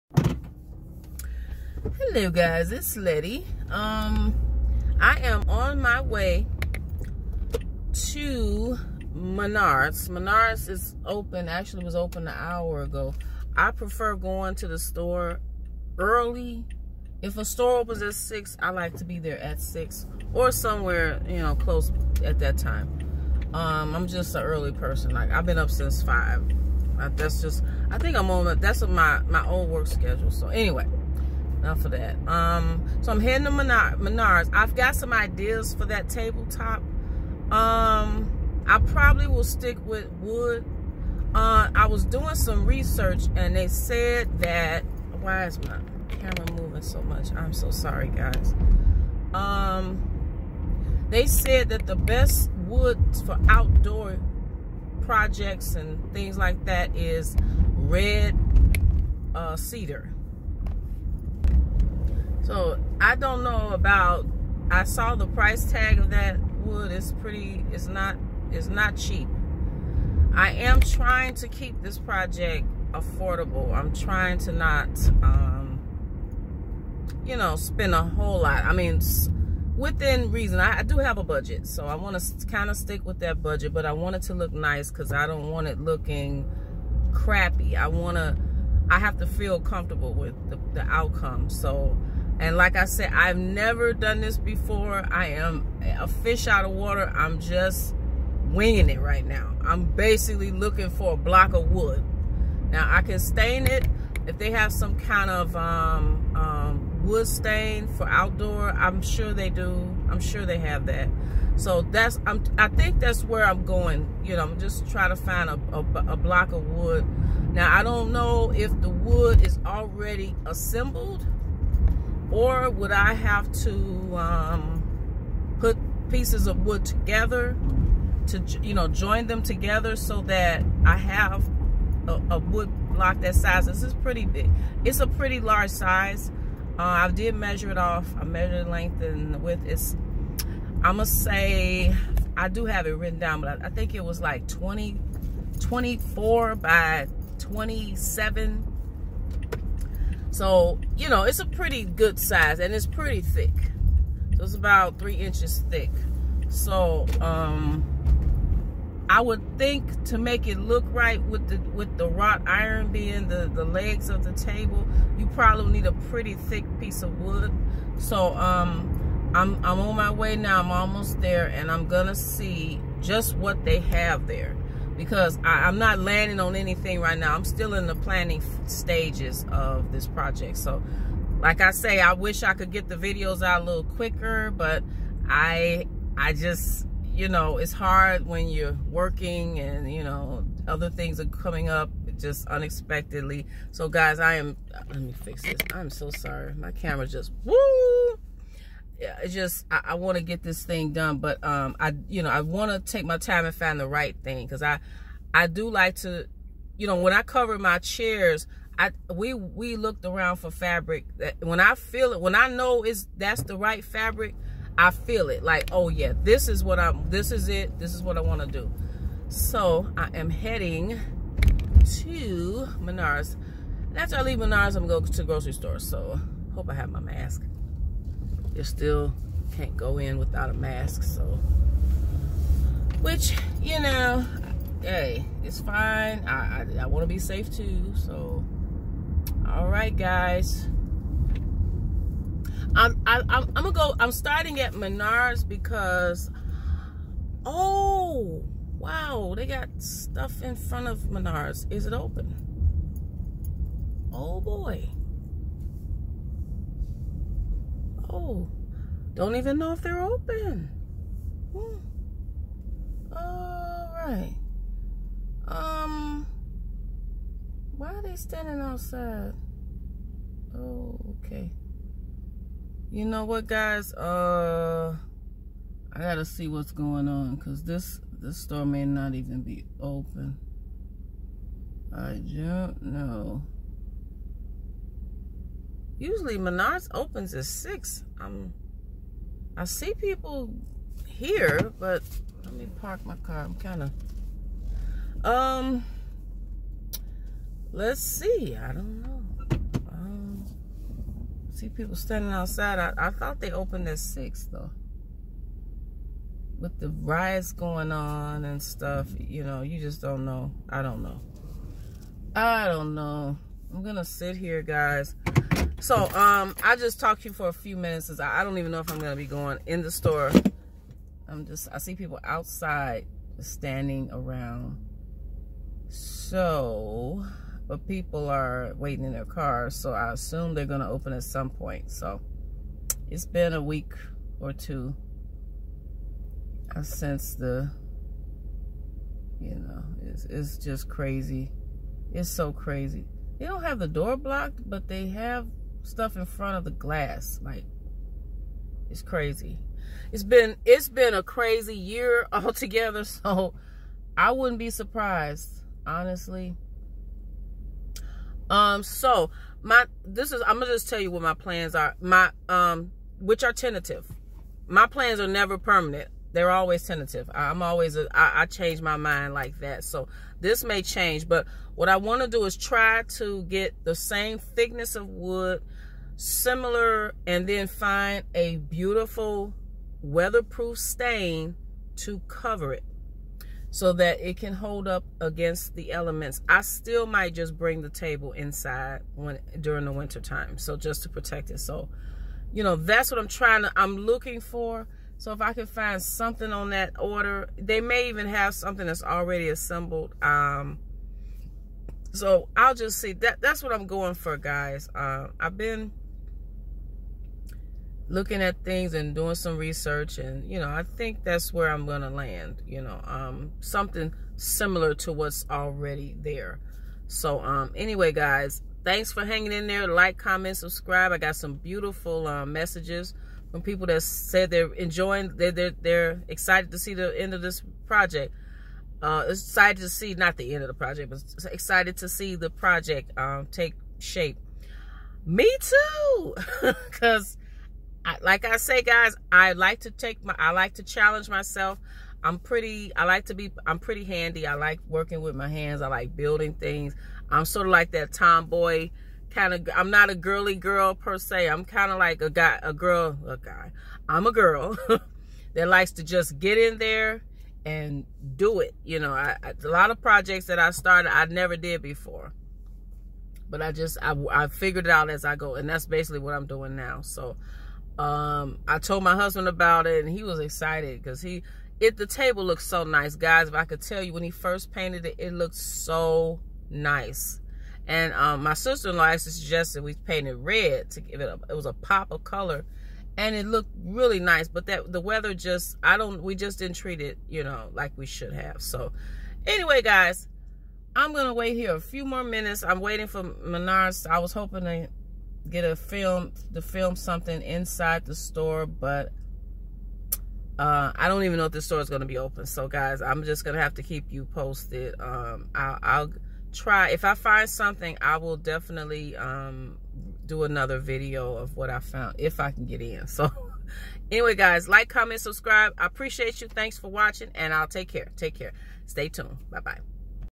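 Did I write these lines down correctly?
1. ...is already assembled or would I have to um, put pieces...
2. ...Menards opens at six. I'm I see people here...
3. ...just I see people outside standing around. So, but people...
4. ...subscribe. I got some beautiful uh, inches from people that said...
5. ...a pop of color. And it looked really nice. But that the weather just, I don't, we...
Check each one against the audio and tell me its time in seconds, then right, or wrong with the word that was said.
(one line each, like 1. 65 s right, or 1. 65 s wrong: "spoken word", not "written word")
1. 119 s right
2. 286 s right
3. 321 s right
4. 420 s wrong: "messages", not "inches"
5. 481 s right.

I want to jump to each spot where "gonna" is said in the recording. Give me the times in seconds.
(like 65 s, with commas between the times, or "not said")
171 s, 243 s, 313 s, 318 s, 330 s, 360 s, 411 s.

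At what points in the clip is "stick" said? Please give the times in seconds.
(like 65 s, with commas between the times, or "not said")
39 s, 82 s.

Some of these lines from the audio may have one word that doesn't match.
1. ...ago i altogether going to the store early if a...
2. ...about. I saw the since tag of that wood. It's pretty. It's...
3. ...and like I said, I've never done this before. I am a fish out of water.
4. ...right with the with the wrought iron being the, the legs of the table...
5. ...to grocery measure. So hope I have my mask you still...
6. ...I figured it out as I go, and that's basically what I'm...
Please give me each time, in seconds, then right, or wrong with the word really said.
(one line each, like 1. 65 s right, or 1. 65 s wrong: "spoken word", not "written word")
1. 12 s wrong: "prefer", not "altogether"
2. 63 s wrong: "price", not "since"
3. 92 s right
4. 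160 s right
5. 225 s wrong: "store", not "measure"
6. 464 s right.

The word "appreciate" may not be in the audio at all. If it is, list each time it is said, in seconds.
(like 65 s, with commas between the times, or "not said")
515 s.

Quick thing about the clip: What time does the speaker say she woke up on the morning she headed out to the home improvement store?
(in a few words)
5.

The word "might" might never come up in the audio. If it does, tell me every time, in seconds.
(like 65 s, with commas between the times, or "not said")
387 s.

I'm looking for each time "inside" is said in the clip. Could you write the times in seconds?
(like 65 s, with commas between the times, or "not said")
388 s, 497 s.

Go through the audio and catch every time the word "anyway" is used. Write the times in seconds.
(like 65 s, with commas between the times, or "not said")
30 s, 417 s, 489 s, 514 s.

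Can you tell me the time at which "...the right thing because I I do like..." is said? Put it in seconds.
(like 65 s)
203 s.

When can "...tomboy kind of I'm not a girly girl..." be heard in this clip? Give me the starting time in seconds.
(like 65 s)
448 s.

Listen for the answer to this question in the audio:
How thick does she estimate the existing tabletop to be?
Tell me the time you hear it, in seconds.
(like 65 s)
154 s.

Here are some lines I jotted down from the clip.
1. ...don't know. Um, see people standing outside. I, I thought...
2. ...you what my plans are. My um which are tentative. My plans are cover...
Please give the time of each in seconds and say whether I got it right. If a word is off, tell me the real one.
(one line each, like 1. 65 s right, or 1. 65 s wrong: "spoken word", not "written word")
1. 298 s right
2. 360 s wrong: "never", not "cover".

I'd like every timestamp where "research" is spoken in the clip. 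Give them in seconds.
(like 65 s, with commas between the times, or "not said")
42 s, 409 s.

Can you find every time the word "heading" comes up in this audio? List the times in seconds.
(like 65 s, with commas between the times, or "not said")
33 s, 220 s.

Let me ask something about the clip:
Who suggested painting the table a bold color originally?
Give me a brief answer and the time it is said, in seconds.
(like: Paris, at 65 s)
sister-in-law, at 478 s.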